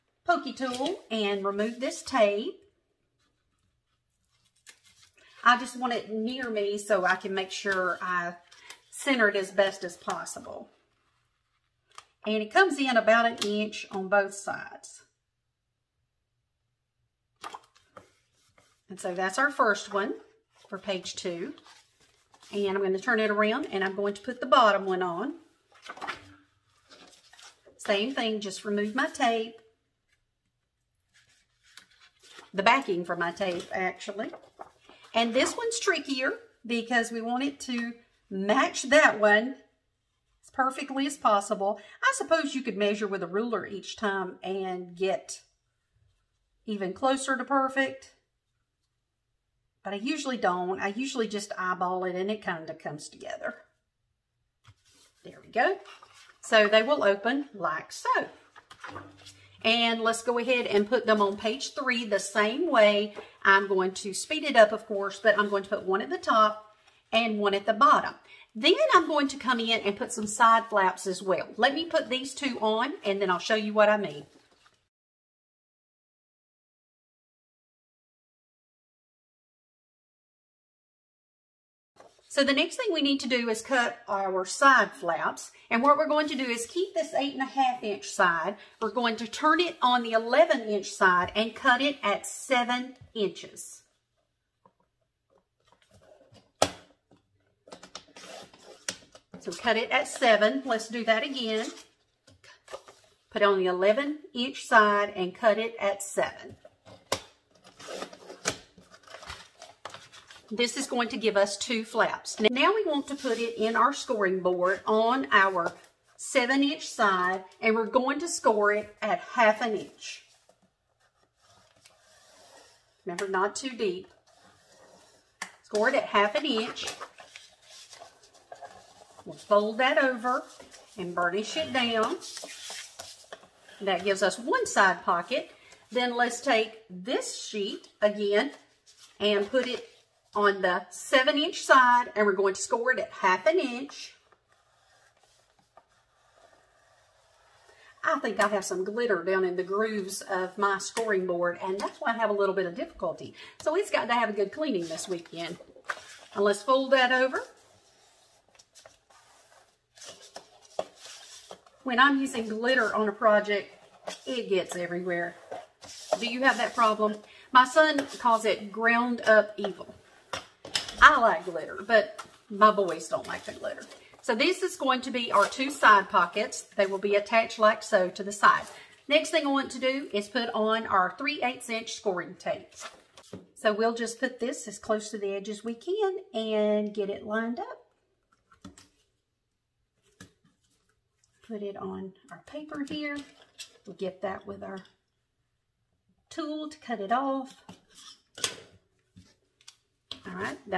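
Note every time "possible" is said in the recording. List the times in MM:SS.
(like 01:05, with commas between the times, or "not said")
00:09, 00:41.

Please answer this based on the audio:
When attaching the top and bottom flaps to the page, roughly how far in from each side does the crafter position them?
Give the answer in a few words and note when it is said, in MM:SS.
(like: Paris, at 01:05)
about an inch, at 00:12.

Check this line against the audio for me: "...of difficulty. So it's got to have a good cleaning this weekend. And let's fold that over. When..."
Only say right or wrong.
right.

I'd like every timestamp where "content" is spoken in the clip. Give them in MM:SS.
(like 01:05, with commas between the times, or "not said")
not said.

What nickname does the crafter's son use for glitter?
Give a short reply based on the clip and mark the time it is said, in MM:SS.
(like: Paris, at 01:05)
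ground up evil, at 02:48.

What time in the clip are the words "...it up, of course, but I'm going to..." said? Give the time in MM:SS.
01:04.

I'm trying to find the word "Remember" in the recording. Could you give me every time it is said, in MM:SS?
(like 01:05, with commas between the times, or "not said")
02:03.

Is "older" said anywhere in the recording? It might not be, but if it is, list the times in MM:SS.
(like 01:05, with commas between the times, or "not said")
not said.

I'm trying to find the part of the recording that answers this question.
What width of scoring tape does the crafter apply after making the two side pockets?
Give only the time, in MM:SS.
03:01.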